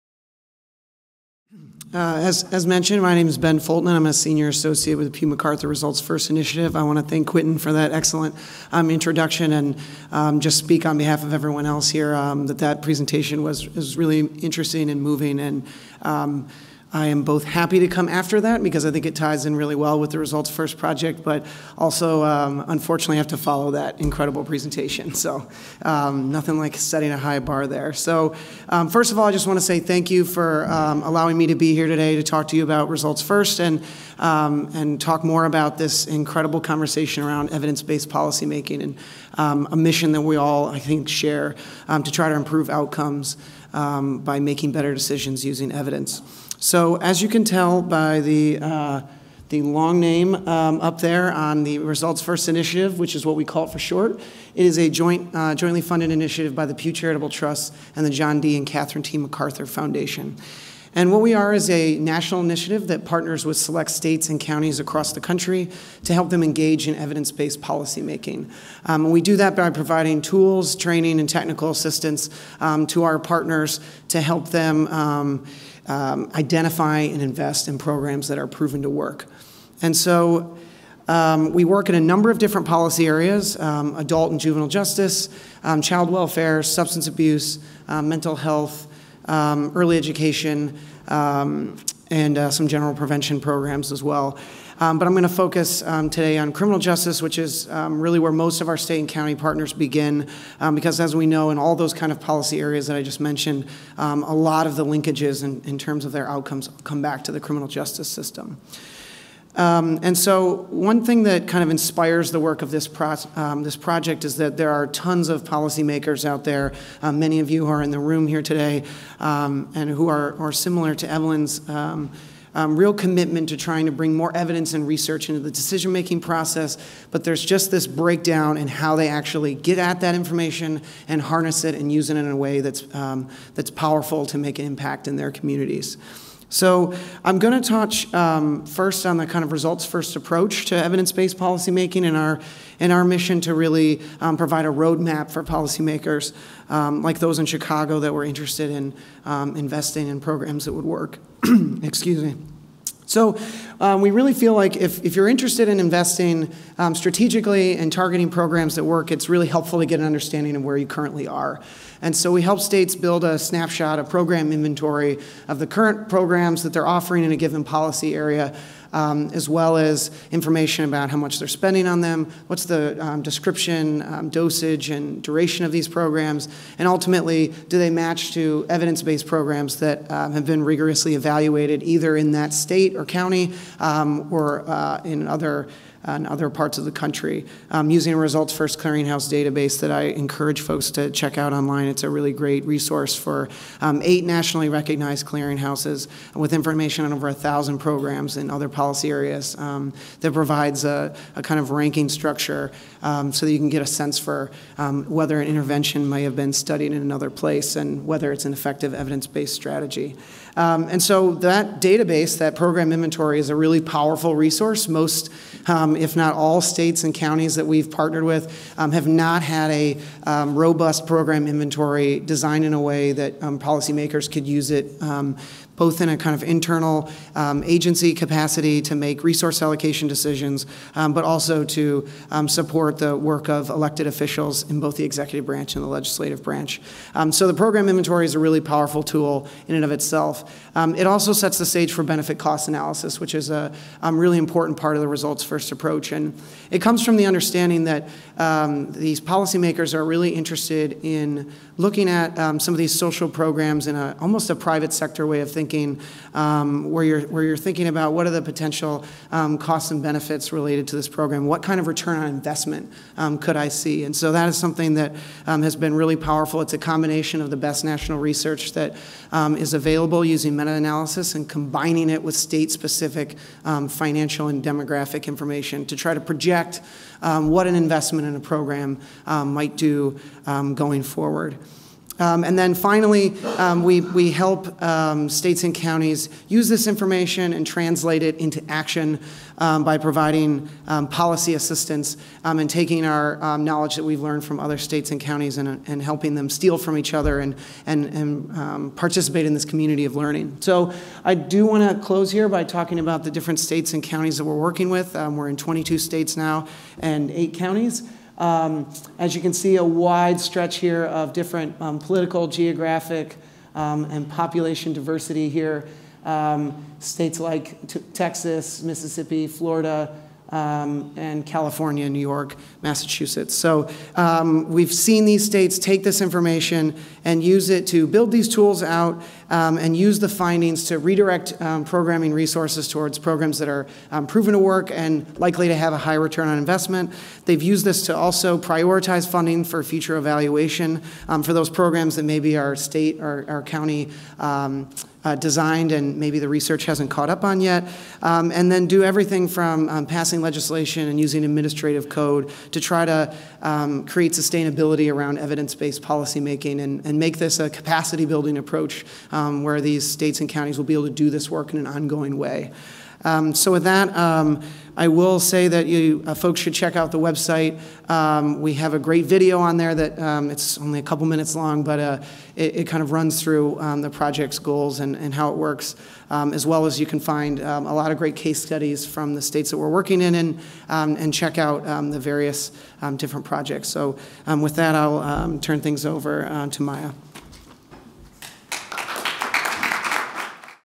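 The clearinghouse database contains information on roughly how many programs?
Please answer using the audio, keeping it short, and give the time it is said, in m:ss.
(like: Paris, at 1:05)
Over 1,000, at 3:17.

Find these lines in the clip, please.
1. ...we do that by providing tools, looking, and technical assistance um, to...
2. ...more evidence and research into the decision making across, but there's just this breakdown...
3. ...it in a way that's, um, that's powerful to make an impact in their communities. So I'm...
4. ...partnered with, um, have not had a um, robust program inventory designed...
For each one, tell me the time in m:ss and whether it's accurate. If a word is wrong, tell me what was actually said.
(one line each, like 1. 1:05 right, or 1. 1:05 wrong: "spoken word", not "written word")
1. 1:09 wrong: "training", not "looking"
2. 2:04 wrong: "process", not "across"
3. 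2:12 right
4. 3:37 right.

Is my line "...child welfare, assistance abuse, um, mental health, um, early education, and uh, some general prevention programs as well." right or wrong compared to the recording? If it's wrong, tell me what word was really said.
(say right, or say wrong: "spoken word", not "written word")
wrong: "substance", not "assistance".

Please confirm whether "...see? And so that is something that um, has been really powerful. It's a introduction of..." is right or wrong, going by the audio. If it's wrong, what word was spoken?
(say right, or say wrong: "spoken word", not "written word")
wrong: "combination", not "introduction".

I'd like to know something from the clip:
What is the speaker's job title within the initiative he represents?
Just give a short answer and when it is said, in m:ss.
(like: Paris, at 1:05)
Senior associate, at 0:04.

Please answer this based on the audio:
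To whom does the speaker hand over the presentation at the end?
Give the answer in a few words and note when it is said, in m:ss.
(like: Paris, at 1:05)
Maya, at 6:26.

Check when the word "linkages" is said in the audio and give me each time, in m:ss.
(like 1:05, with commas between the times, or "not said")
1:44.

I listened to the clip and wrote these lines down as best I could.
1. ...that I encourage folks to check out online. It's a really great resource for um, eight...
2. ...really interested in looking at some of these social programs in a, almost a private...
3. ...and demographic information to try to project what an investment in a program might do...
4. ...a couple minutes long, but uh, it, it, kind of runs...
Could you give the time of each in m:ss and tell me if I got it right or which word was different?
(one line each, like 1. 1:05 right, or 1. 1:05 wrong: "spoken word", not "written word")
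1. 3:09 right
2. 4:10 right
3. 4:34 right
4. 6:10 right.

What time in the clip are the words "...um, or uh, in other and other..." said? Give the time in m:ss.
3:03.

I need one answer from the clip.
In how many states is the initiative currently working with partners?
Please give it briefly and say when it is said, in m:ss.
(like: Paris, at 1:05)
22, at 5:05.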